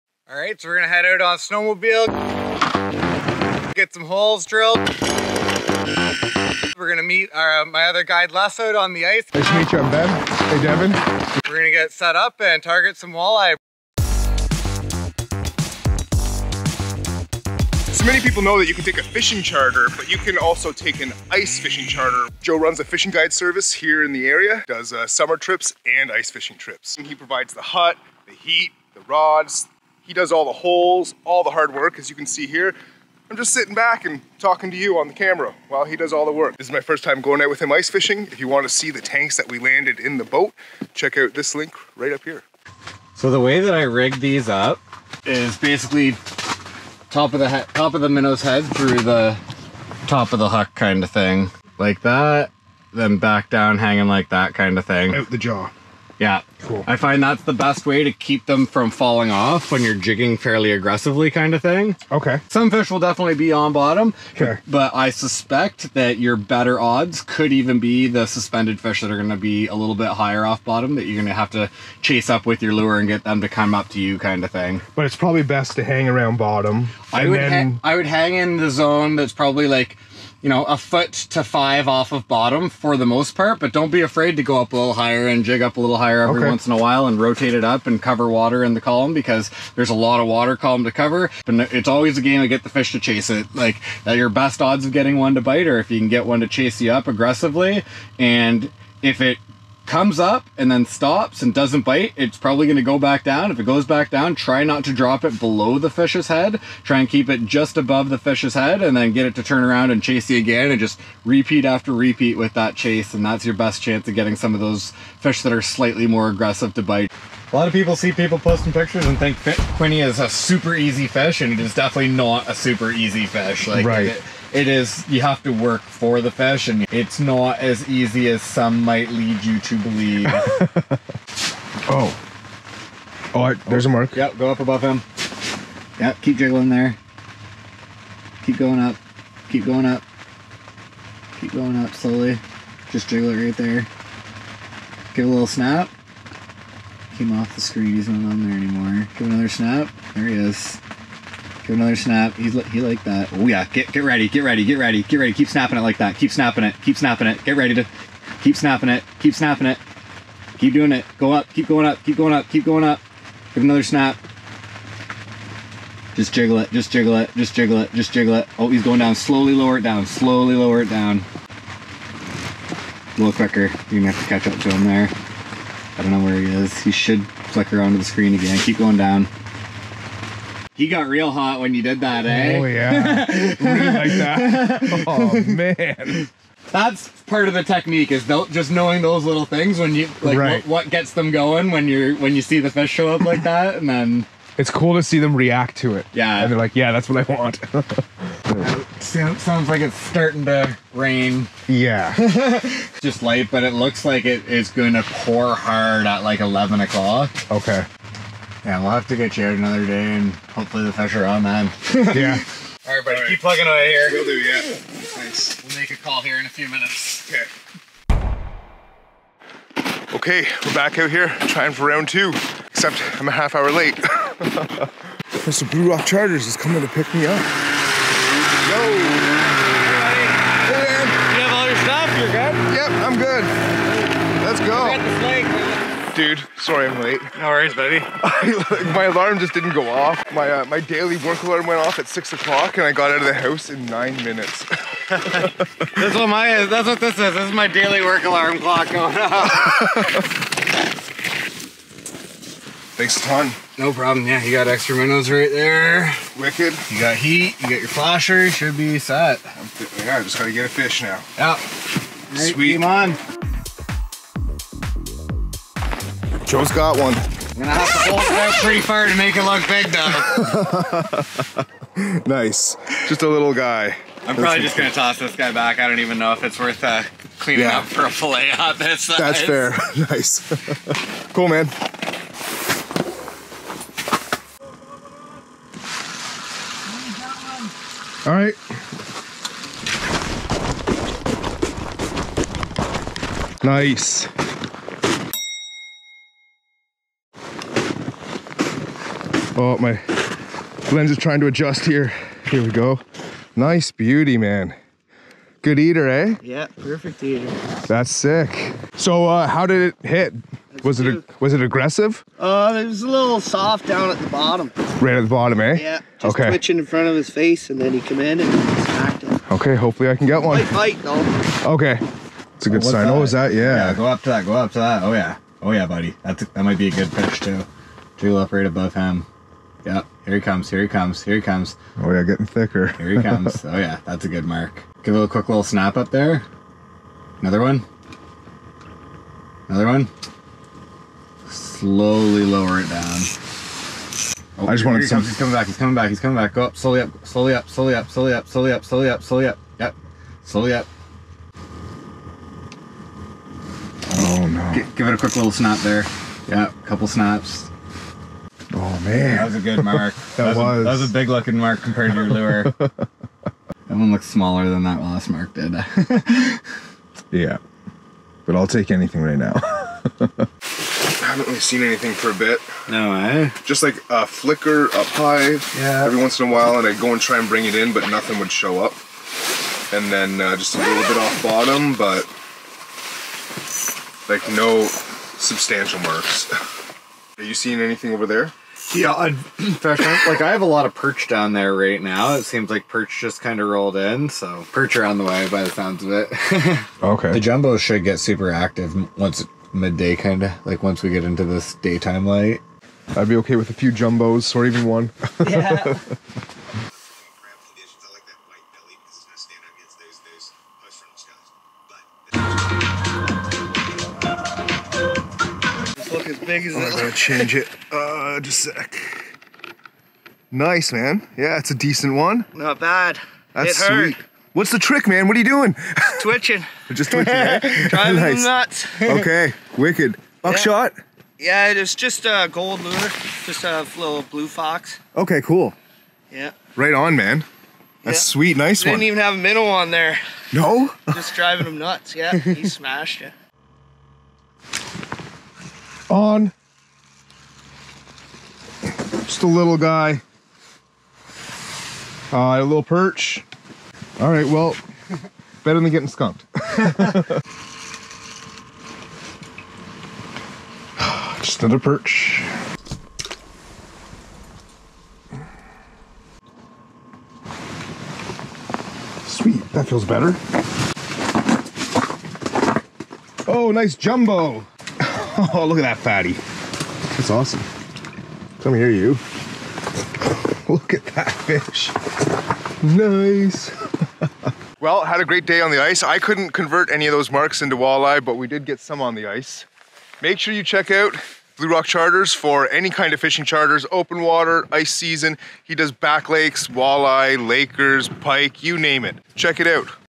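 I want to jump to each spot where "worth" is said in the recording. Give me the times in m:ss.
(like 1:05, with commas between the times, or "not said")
4:36.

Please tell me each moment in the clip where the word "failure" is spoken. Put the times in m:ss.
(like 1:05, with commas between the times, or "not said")
not said.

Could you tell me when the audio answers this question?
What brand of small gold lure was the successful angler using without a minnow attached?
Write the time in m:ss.
7:14.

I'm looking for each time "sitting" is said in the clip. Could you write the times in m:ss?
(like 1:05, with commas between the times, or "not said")
0:33.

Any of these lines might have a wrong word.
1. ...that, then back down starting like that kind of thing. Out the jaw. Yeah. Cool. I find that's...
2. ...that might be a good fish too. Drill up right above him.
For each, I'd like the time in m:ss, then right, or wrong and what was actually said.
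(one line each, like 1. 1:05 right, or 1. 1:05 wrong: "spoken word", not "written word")
1. 0:52 wrong: "hanging", not "starting"
2. 5:26 right.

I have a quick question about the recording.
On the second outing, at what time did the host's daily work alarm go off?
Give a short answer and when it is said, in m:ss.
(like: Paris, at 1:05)
6 o'clock, at 4:02.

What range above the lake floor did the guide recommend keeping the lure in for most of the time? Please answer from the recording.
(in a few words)
A foot to five.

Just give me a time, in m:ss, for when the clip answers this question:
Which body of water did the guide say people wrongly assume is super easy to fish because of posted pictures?
1:59.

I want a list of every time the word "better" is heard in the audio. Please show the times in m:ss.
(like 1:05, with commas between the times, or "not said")
1:06, 7:35, 7:50.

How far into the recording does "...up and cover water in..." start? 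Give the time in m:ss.
1:27.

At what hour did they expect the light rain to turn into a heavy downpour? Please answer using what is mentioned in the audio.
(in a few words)
11 o'clock.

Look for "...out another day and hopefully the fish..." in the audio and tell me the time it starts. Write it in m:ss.
3:29.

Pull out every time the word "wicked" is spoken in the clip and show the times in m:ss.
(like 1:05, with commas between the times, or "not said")
4:16, 7:09.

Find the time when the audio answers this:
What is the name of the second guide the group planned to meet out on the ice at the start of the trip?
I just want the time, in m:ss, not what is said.
0:08.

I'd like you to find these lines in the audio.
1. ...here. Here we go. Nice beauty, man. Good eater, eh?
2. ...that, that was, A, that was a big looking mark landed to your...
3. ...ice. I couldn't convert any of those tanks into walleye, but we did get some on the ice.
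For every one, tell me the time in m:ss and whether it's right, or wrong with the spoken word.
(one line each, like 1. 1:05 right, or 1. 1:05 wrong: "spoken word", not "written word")
1. 5:01 right
2. 6:00 wrong: "compared", not "landed"
3. 8:05 wrong: "marks", not "tanks".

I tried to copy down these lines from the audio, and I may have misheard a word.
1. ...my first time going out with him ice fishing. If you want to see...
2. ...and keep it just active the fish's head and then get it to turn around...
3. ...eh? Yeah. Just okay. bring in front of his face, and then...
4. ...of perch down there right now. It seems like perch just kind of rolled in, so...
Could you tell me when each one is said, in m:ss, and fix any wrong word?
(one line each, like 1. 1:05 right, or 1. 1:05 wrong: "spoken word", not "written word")
1. 0:36 right
2. 1:46 wrong: "above", not "active"
3. 5:15 wrong: "twitching", not "bring"
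4. 6:30 right.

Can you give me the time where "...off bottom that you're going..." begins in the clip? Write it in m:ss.
1:10.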